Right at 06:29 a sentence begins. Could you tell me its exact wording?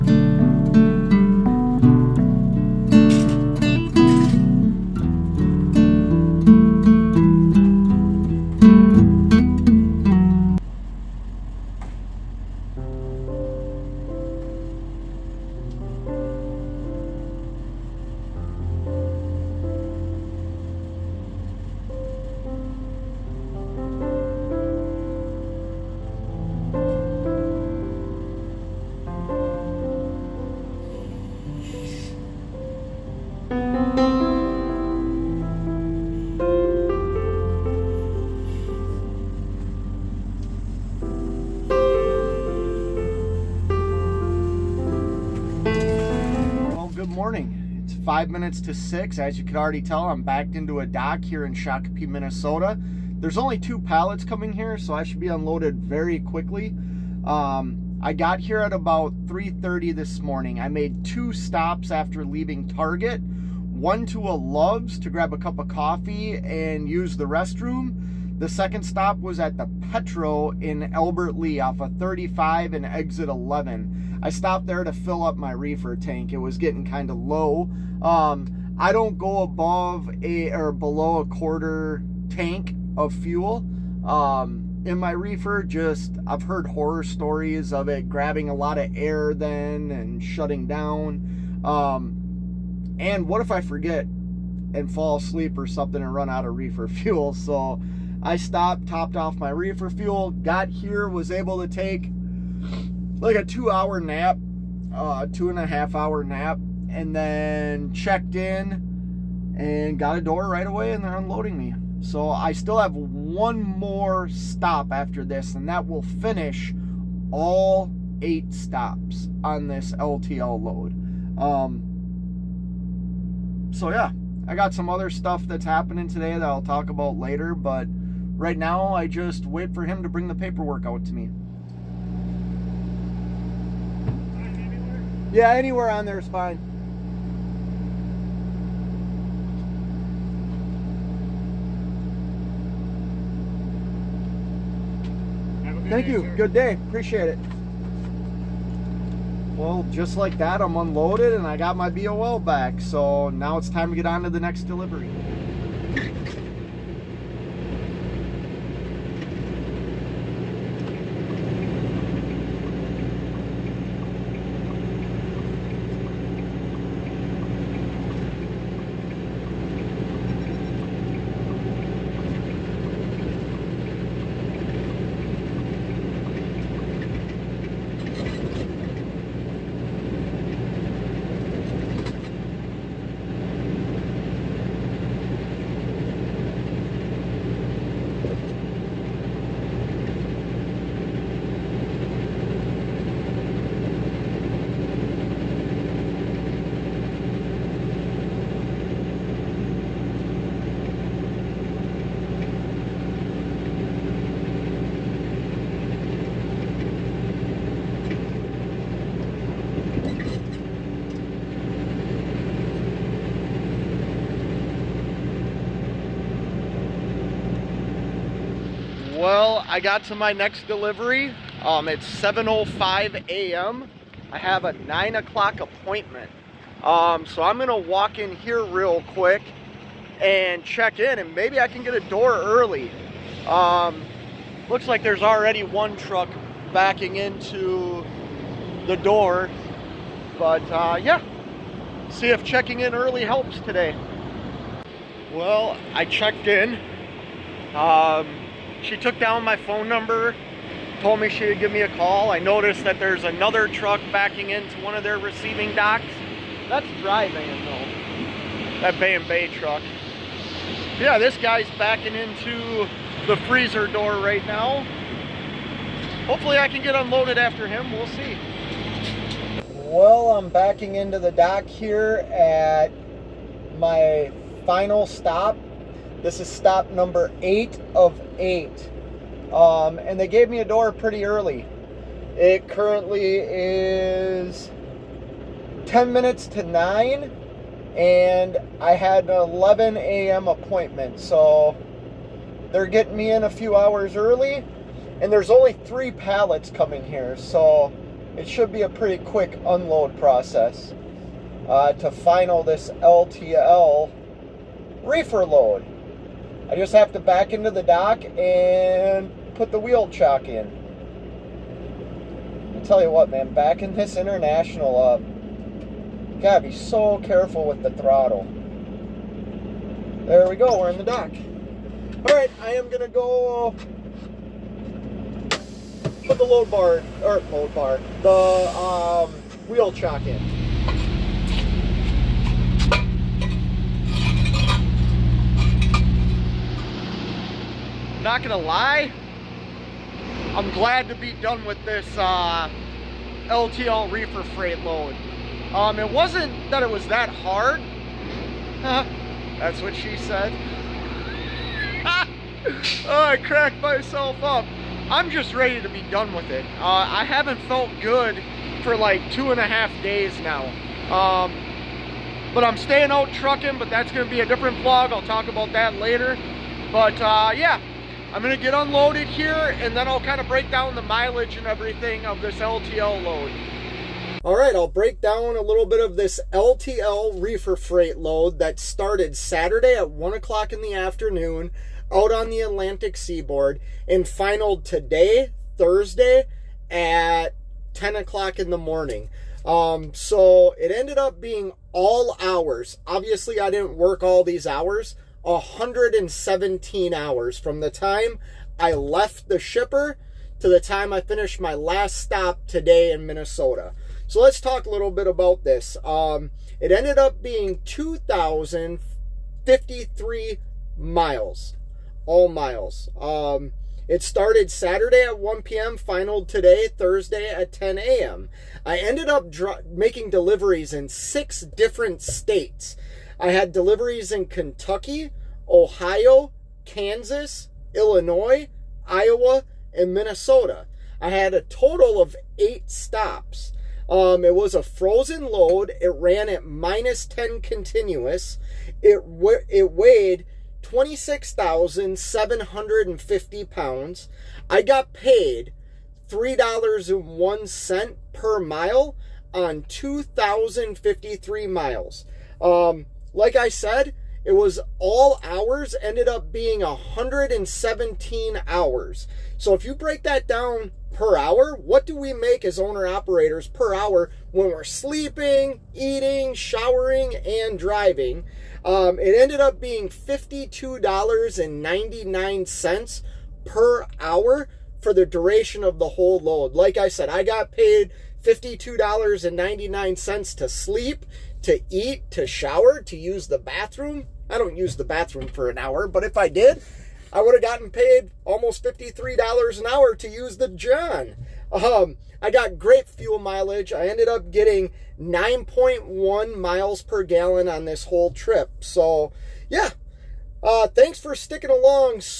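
Um, so it ended up being all hours.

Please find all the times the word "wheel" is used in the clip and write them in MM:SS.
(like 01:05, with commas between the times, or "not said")
05:09, 05:29.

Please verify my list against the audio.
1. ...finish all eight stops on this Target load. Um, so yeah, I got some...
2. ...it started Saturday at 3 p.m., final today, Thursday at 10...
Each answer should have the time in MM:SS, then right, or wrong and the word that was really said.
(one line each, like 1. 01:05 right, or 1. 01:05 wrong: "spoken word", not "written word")
1. 01:56 wrong: "LTL", not "Target"
2. 06:54 wrong: "1", not "3".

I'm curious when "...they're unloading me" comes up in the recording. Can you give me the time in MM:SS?
01:51.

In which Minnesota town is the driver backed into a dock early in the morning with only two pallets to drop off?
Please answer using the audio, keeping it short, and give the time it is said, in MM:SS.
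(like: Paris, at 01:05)
Shakopee, at 00:51.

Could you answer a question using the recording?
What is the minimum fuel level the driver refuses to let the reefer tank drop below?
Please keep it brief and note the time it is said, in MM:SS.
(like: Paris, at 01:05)
a quarter tank, at 01:21.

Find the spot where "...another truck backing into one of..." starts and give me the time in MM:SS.
04:13.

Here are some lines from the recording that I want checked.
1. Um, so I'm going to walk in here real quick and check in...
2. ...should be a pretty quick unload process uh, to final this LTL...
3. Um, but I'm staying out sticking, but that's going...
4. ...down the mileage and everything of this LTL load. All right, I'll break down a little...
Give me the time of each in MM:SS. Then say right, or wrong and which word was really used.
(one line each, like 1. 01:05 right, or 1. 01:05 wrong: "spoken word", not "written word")
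1. 03:46 right
2. 04:58 right
3. 06:01 wrong: "trucking", not "sticking"
4. 06:10 right.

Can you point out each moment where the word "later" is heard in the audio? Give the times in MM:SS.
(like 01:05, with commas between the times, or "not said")
02:07, 06:05.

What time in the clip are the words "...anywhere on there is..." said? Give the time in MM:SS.
02:15.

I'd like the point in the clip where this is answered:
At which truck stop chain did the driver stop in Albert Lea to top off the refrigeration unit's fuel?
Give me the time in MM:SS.
01:09.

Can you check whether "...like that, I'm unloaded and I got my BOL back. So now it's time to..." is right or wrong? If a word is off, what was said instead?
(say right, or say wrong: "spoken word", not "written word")
right.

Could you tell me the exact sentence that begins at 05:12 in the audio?
I tell you what, man, backing this international up, you gotta be so careful with the throttle.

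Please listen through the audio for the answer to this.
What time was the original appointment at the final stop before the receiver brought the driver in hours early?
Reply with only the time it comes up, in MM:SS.
04:49.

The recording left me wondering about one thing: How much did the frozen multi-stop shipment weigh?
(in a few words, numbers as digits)
26,750 pounds.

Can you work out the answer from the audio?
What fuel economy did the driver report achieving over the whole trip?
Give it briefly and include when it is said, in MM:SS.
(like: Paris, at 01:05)
9.1 miles per gallon, at 08:15.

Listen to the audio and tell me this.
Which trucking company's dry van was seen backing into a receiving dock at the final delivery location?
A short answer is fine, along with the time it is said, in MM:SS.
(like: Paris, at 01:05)
Bay and Bay, at 04:18.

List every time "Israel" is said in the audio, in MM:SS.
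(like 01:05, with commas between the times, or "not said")
not said.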